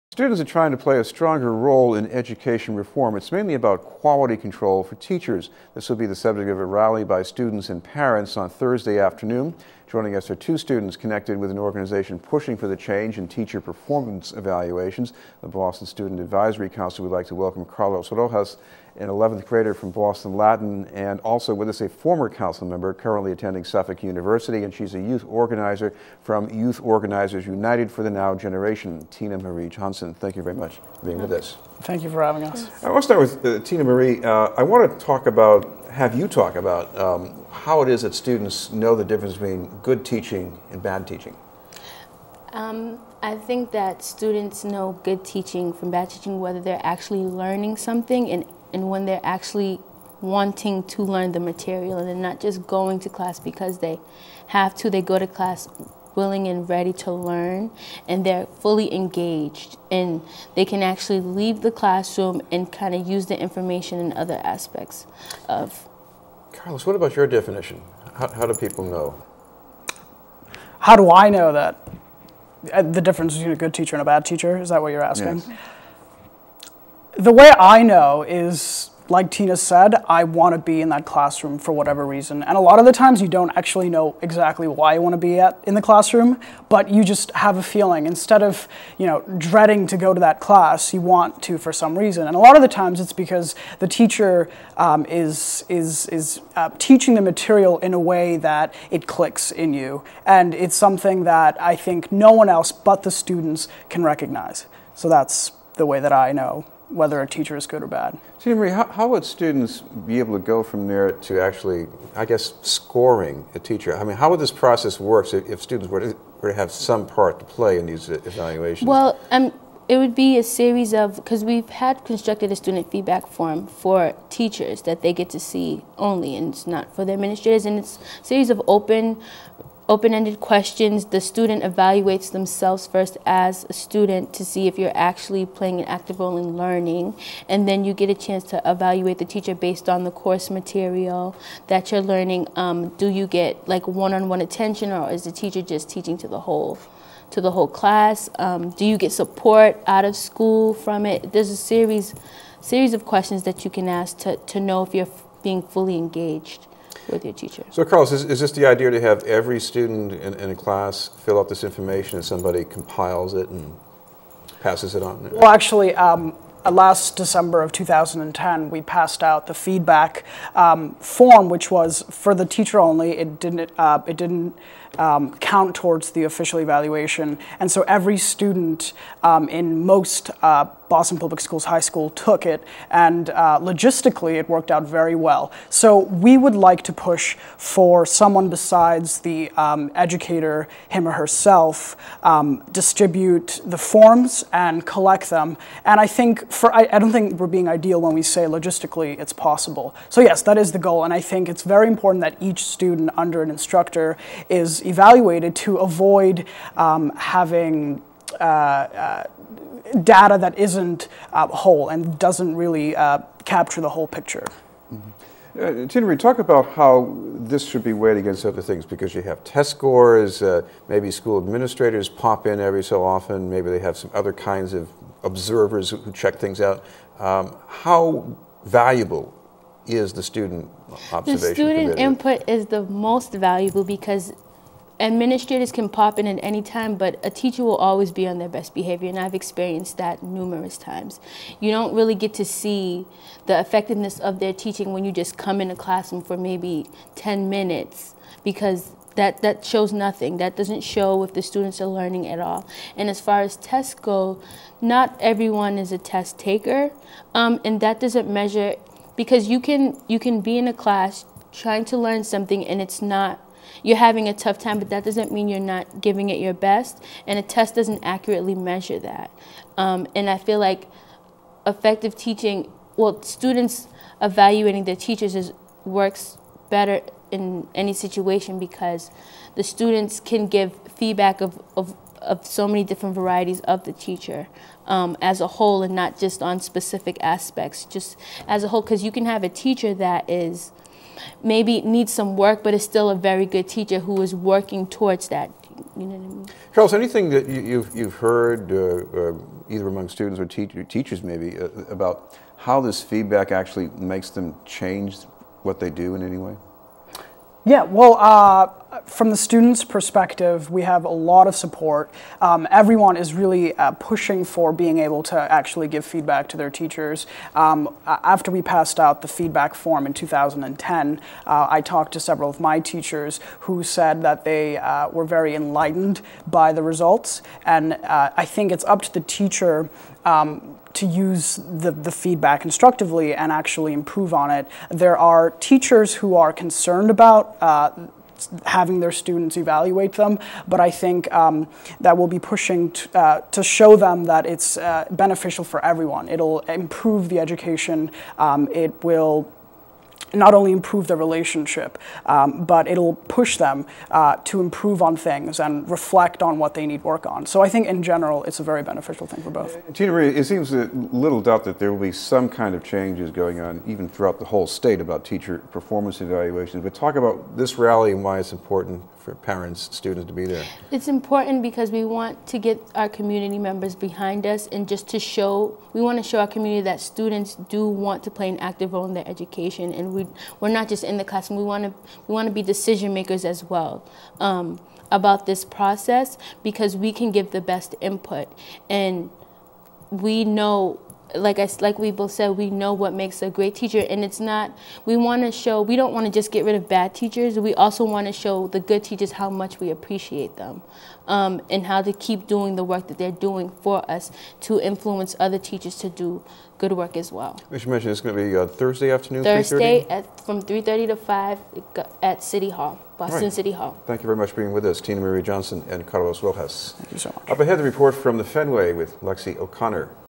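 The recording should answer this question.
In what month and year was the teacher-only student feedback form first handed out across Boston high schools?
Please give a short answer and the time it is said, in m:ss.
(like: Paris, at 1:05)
December 2010, at 2:47.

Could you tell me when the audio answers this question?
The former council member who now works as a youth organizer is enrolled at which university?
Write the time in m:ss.
0:23.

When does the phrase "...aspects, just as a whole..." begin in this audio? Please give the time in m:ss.
4:47.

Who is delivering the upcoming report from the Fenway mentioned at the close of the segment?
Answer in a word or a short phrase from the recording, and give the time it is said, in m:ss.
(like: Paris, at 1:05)
Lexi O'Connor, at 6:59.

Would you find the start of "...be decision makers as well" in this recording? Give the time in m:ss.
6:22.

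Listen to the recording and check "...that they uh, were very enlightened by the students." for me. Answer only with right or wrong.
wrong.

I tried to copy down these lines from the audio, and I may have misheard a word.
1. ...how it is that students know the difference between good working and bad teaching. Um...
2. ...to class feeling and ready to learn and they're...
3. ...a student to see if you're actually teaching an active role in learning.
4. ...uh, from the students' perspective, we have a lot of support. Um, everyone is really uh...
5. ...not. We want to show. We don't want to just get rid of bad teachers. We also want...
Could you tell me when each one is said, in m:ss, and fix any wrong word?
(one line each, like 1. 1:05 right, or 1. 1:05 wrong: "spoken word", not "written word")
1. 0:37 wrong: "teaching", not "working"
2. 0:55 wrong: "willing", not "feeling"
3. 2:13 wrong: "playing", not "teaching"
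4. 5:08 right
5. 6:34 right.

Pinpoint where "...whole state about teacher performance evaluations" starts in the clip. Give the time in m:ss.
6:04.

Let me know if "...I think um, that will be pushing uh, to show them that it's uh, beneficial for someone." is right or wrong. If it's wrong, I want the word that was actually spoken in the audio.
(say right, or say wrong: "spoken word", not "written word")
wrong: "everyone", not "someone".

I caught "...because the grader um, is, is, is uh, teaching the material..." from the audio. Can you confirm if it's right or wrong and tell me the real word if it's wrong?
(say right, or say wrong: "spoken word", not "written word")
wrong: "teacher", not "grader".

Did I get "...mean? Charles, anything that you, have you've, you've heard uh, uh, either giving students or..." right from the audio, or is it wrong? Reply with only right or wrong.
wrong.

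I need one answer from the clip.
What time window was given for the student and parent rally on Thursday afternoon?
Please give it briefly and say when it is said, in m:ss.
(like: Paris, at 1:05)
3:30 to 5, at 6:50.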